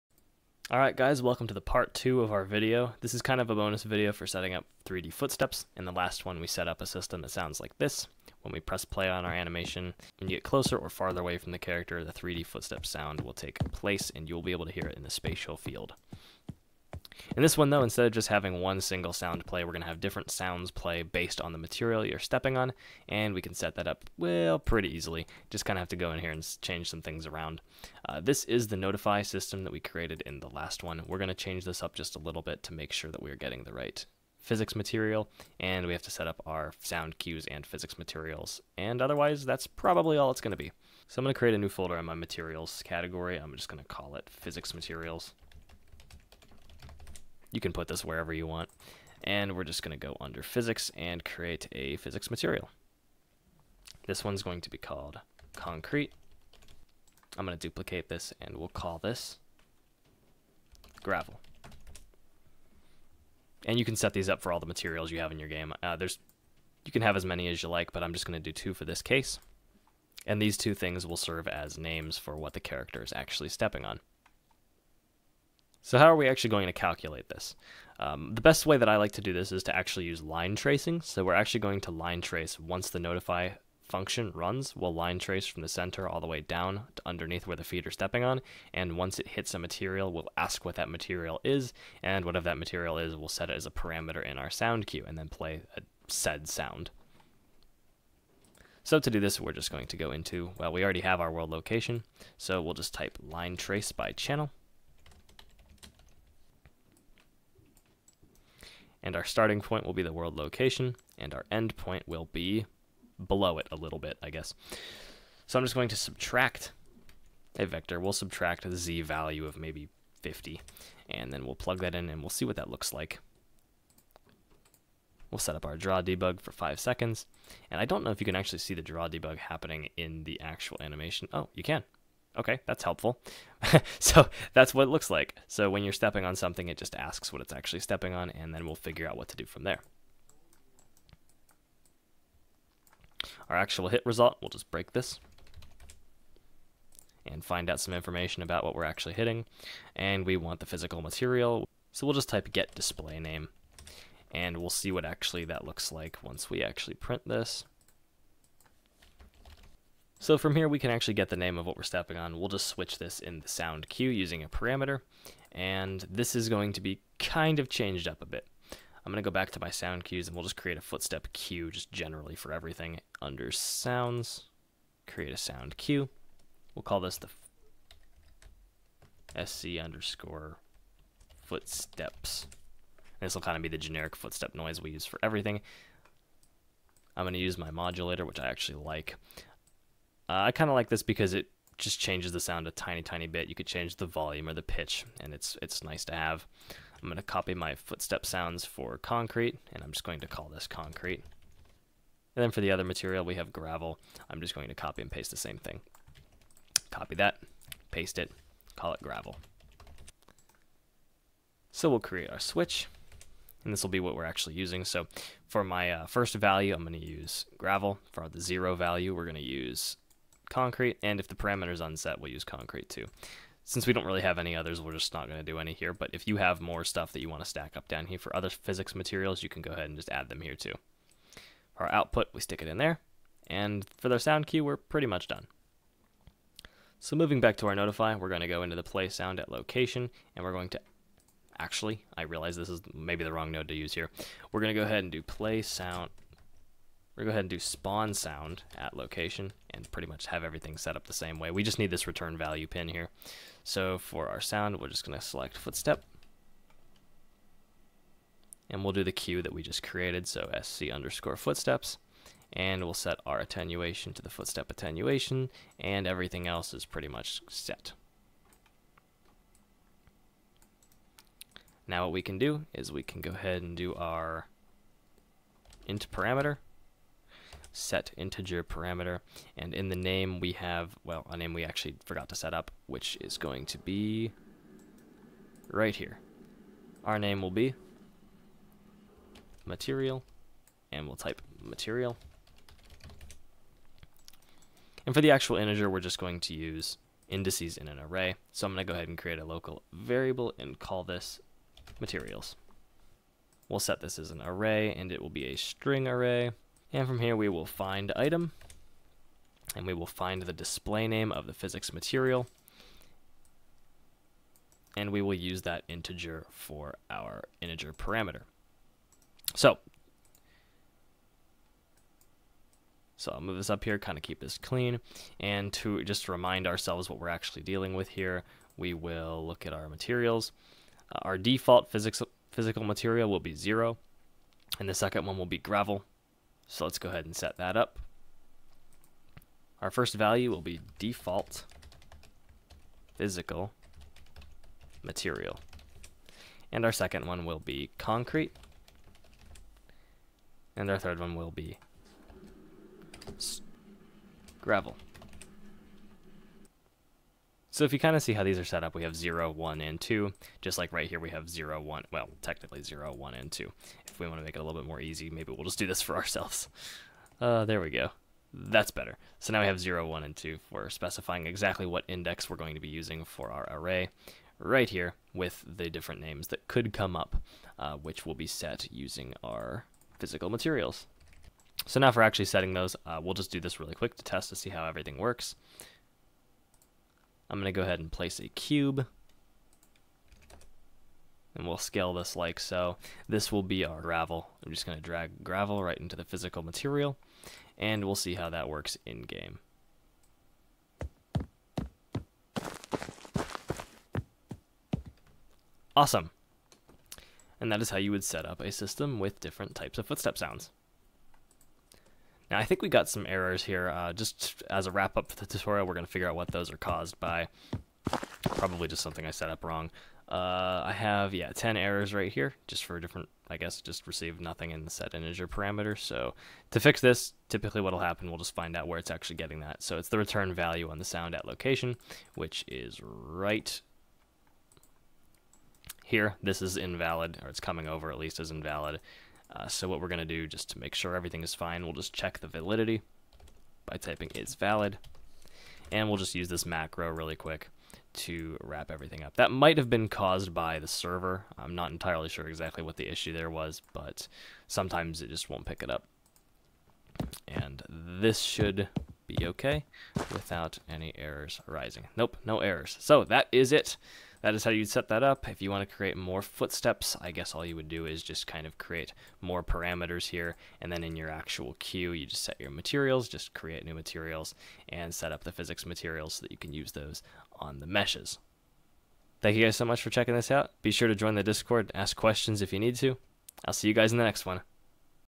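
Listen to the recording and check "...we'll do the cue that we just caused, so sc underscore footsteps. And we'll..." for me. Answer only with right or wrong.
wrong.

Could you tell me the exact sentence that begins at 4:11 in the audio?
We just need this return value pin here.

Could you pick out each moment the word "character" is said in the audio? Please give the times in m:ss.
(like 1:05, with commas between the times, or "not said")
0:11, 1:12.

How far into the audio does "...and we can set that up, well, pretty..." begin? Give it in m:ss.
0:23.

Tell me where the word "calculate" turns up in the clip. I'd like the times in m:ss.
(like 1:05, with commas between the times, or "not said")
1:16.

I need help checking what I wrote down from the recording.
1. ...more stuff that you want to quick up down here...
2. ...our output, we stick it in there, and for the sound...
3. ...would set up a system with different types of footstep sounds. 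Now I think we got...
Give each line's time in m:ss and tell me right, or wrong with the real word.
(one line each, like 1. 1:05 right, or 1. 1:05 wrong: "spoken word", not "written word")
1. 3:46 wrong: "stack", not "quick"
2. 3:51 right
3. 6:48 right.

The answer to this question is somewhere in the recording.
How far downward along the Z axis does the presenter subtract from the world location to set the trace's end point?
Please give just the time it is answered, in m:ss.
2:00.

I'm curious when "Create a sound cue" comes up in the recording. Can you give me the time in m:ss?
2:55.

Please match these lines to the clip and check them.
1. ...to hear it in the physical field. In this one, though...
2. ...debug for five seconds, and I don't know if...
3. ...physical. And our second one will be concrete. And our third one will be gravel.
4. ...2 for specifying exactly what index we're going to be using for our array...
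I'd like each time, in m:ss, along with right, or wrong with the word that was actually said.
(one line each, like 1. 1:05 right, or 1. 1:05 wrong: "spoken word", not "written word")
1. 0:14 wrong: "spatial", not "physical"
2. 2:06 right
3. 5:45 wrong: "material", not "physical"
4. 6:10 right.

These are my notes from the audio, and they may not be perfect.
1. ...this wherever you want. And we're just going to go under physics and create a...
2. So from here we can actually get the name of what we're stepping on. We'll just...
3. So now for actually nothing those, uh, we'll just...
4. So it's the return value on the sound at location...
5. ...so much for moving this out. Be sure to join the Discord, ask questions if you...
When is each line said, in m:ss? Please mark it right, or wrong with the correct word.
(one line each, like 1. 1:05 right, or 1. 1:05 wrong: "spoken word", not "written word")
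1. 0:47 right
2. 2:40 right
3. 6:21 wrong: "setting", not "nothing"
4. 7:09 right
5. 7:59 wrong: "checking", not "moving".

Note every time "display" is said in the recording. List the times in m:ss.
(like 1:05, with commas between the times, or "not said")
2:32, 5:10.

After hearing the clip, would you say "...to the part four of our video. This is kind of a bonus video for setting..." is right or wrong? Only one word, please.
wrong.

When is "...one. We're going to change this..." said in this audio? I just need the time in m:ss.
0:30.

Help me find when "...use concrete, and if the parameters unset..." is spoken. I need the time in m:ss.
3:39.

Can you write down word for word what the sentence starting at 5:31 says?
Uh, our default physics, physical material will be zero, and the second one will be gravel.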